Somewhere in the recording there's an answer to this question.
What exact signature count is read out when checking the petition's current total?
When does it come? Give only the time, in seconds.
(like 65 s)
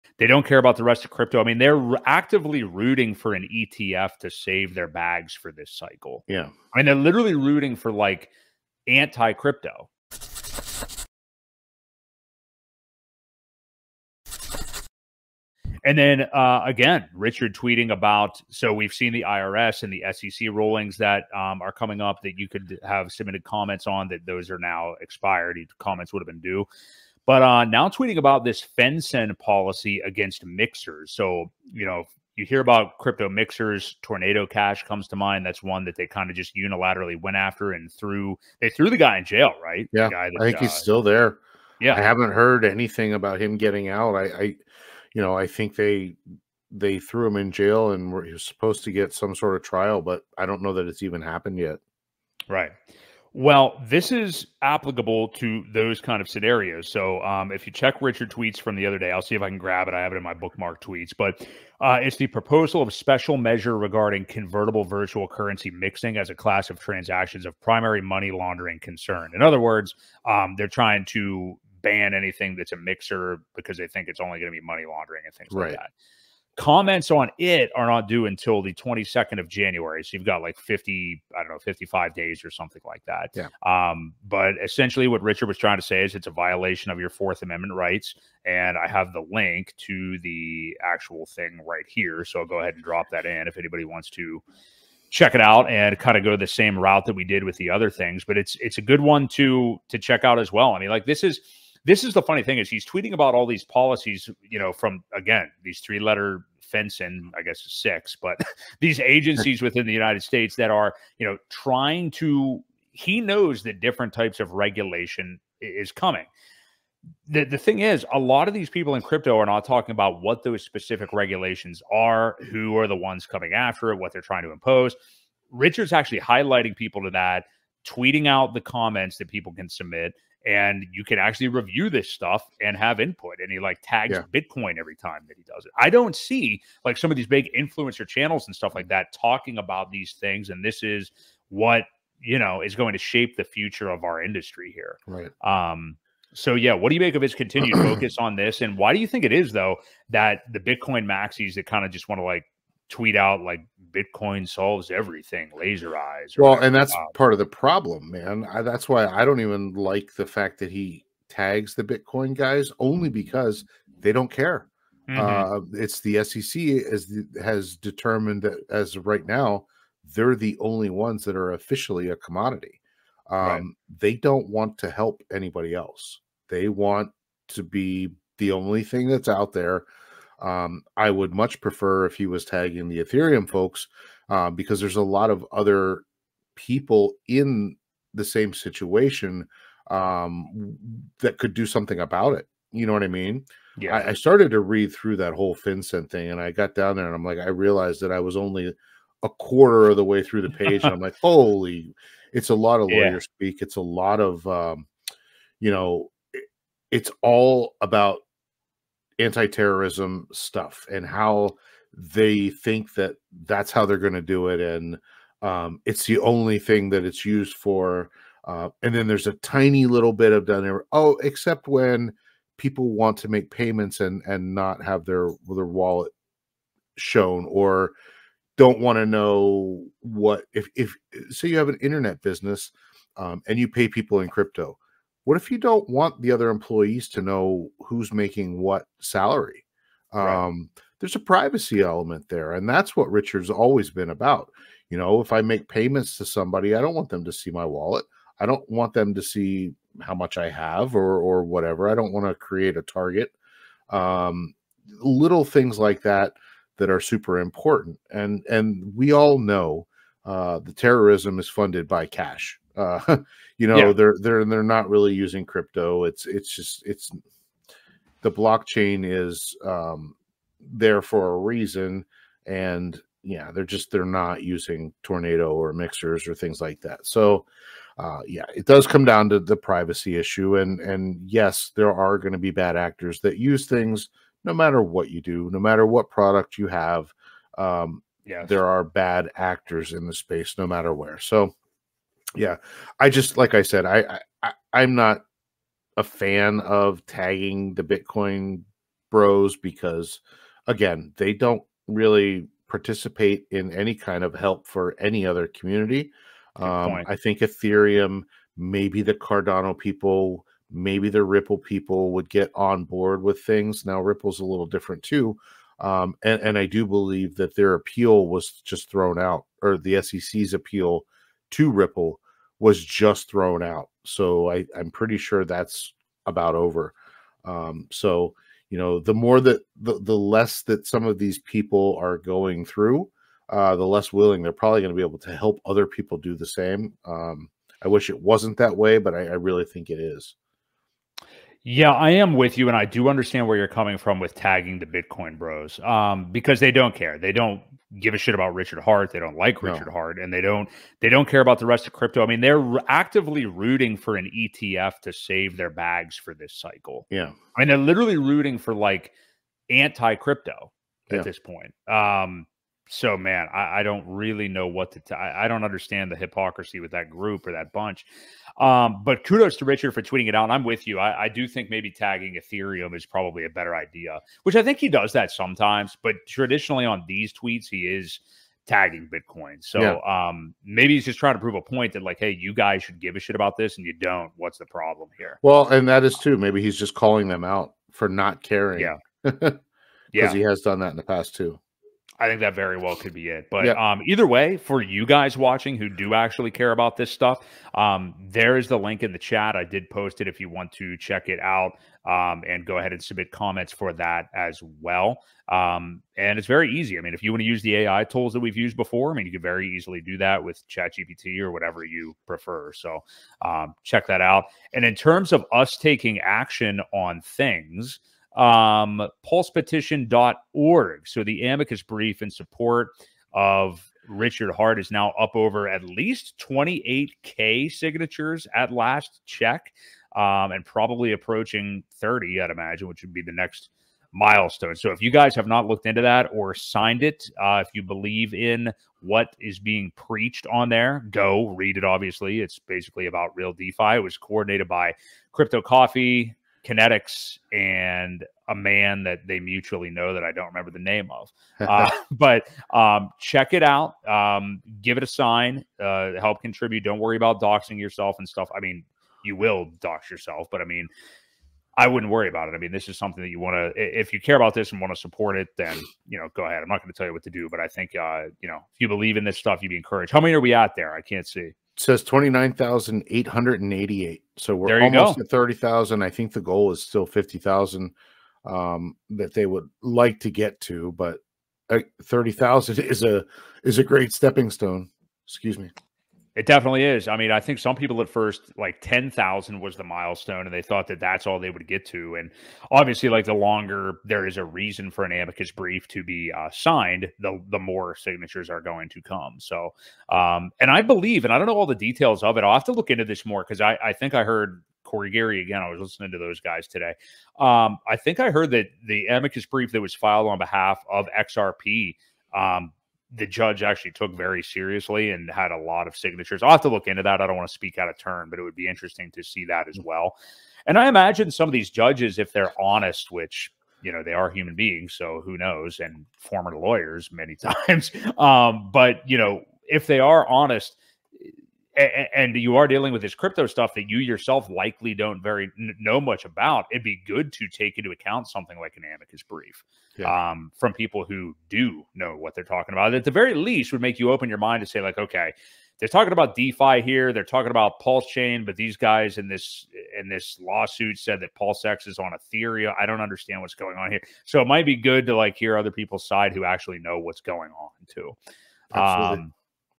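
472 s.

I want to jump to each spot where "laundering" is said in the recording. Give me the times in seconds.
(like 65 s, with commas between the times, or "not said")
68 s, 74 s.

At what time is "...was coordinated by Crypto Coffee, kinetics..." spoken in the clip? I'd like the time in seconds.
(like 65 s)
444 s.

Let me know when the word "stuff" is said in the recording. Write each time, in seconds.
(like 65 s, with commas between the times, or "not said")
132 s, 138 s, 210 s, 397 s, 458 s, 469 s, 533 s.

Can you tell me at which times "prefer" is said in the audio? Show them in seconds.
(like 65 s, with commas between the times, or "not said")
181 s, 412 s.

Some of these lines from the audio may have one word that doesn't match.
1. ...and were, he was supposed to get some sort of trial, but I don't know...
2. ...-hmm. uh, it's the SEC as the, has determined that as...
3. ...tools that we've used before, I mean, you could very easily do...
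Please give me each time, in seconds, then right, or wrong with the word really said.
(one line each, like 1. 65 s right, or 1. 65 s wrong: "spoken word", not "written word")
1. 47 s right
2. 165 s right
3. 408 s right.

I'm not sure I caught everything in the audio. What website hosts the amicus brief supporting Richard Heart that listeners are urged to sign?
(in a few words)
pulsepetition.org.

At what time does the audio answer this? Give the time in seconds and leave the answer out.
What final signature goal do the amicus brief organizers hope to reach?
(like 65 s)
477 s.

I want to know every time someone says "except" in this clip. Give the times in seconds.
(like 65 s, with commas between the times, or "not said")
221 s.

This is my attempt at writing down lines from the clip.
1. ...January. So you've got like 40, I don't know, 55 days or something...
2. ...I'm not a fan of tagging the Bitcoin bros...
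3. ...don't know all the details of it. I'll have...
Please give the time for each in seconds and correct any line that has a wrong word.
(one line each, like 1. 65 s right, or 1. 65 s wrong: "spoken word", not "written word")
1. 79 s wrong: "50", not "40"
2. 294 s right
3. 501 s right.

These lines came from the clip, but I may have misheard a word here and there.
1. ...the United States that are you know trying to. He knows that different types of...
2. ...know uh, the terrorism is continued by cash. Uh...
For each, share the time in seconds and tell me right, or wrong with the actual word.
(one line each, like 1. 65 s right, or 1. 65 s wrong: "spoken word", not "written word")
1. 109 s right
2. 259 s wrong: "funded", not "continued".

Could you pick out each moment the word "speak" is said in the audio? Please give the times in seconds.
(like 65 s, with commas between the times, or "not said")
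203 s, 517 s.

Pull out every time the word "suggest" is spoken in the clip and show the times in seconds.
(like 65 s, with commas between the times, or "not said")
not said.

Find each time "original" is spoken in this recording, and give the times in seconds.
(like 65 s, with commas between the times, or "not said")
not said.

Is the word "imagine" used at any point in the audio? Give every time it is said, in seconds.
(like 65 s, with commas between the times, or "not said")
432 s, 520 s.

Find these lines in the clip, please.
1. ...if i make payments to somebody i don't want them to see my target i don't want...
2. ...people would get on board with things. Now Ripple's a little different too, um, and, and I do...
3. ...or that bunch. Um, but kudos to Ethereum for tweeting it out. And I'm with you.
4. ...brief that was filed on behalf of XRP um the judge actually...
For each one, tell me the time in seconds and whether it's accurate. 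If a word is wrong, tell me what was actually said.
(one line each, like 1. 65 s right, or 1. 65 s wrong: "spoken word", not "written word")
1. 245 s wrong: "wallet", not "target"
2. 311 s right
3. 367 s wrong: "Richard", not "Ethereum"
4. 509 s right.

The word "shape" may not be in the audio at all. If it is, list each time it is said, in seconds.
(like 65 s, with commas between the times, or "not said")
142 s.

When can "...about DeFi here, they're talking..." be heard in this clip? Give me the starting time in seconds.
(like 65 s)
546 s.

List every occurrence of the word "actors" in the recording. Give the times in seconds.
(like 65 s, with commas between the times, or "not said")
282 s, 289 s.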